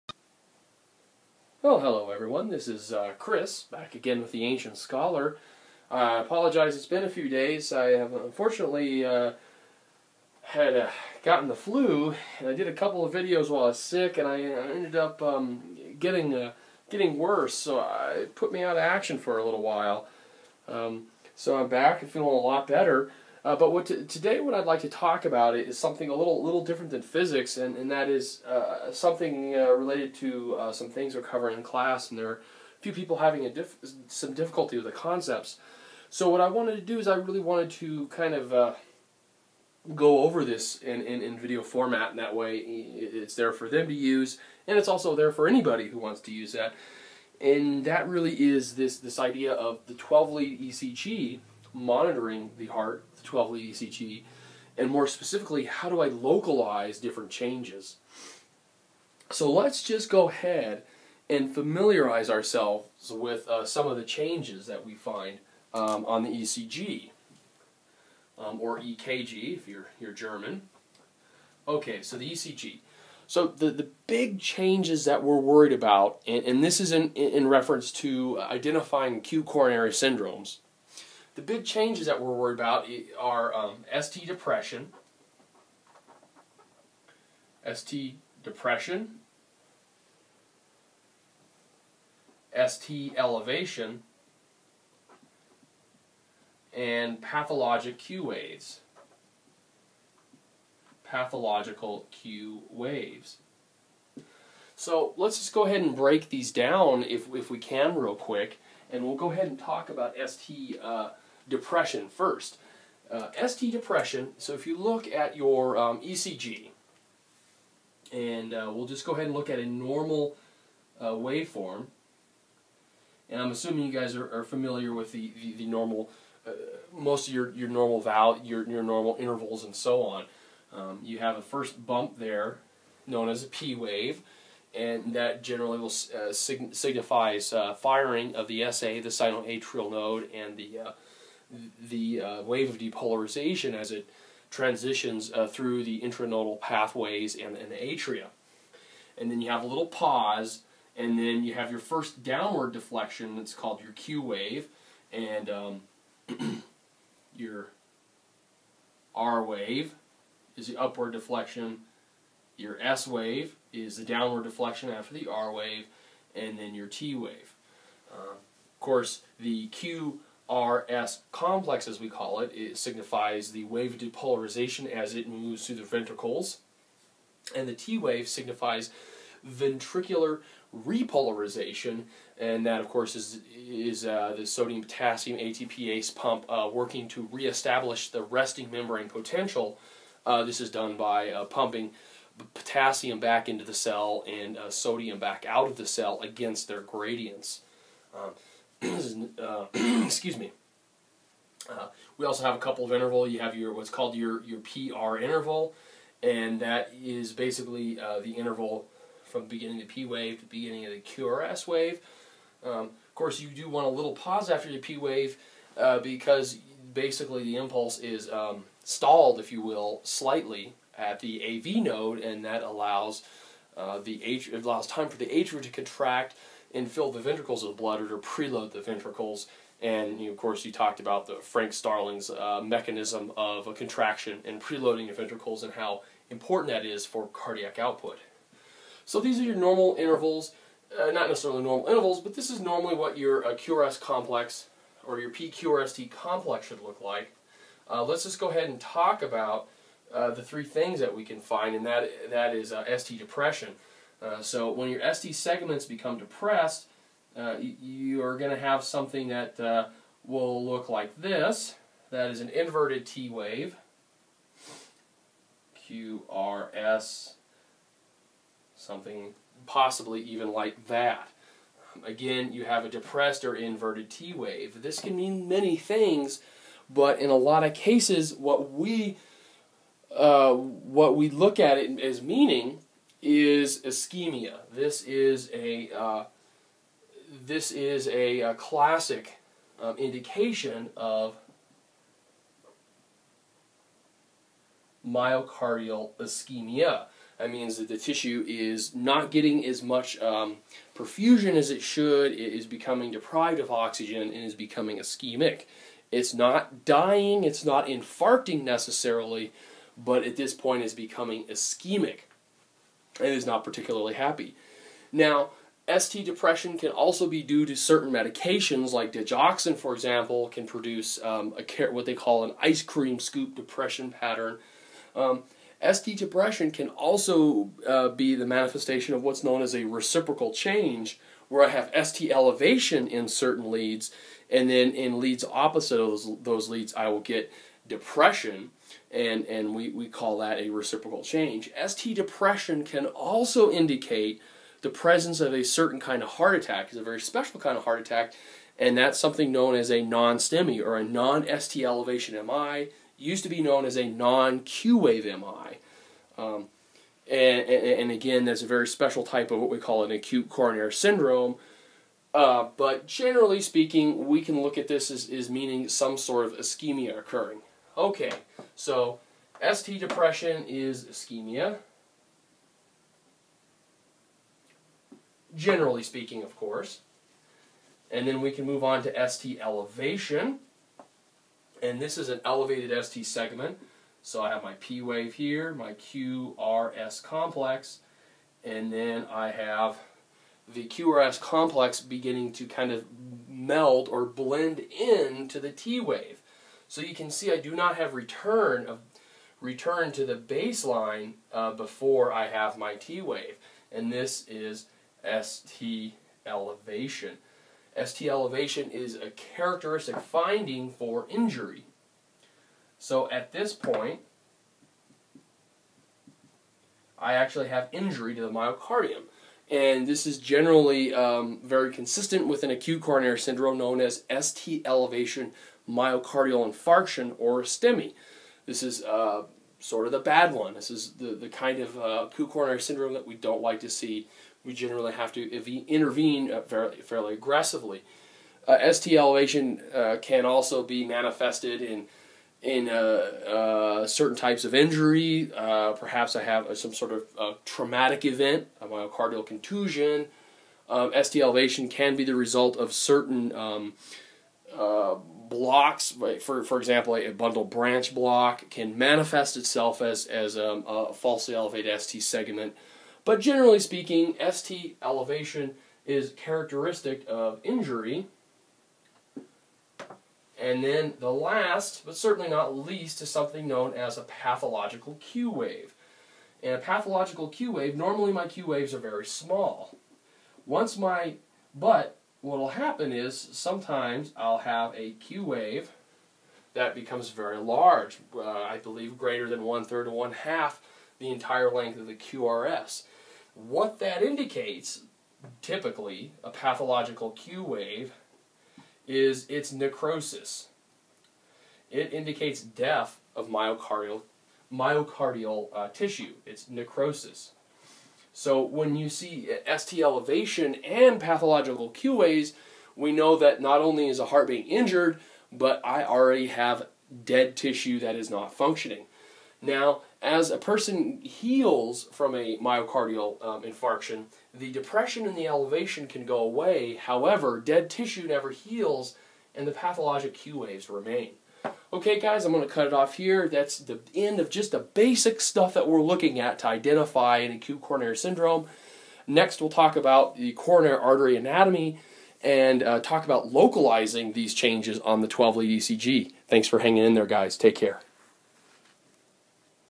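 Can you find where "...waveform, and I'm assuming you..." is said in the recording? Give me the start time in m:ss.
2:01.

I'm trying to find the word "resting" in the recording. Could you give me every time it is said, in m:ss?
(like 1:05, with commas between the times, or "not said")
3:08.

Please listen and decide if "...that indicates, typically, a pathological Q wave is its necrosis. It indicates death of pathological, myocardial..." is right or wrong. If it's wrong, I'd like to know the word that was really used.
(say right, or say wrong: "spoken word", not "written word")
wrong: "myocardial", not "pathological".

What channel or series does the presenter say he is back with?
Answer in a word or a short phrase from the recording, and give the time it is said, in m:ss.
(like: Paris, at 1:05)
The Ancient Scholar, at 0:04.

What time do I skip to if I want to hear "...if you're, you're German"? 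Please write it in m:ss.
1:09.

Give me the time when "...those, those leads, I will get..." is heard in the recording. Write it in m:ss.
5:35.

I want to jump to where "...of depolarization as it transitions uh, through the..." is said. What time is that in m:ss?
2:22.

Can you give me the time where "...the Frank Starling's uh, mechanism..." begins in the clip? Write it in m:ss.
3:51.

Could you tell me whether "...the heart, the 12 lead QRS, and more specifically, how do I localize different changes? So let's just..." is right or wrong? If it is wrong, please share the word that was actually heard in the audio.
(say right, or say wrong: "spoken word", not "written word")
wrong: "ECG", not "QRS".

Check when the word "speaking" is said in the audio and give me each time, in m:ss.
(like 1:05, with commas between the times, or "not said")
6:03, 6:16, 7:43.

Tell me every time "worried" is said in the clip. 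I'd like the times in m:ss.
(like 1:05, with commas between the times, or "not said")
1:15, 1:22.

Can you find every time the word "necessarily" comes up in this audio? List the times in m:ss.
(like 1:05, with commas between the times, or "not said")
4:01, 5:08.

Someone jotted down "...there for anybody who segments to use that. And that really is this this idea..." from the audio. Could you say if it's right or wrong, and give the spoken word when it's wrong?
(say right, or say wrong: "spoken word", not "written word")
wrong: "wants", not "segments".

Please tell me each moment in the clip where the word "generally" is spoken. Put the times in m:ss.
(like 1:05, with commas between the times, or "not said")
2:15, 6:03, 6:15, 7:00, 7:14, 7:43.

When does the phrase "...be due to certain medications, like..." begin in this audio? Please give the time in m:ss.
5:17.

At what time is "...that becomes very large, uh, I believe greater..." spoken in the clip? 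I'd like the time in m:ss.
8:06.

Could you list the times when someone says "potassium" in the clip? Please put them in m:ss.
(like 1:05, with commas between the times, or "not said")
3:04, 3:12.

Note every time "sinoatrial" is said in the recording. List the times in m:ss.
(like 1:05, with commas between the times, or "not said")
2:19.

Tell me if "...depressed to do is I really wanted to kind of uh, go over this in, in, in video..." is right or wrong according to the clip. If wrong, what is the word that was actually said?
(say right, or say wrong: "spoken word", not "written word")
wrong: "wanted", not "depressed".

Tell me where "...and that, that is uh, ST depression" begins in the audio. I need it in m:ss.
4:11.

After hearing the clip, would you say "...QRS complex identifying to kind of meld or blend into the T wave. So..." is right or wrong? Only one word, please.
wrong.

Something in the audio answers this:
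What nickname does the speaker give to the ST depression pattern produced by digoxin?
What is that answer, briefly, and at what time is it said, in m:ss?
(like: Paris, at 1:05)
Ice cream scoop, at 5:22.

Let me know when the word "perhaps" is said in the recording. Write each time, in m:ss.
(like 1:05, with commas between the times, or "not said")
7:25.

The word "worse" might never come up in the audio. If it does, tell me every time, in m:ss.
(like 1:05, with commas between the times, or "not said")
0:17.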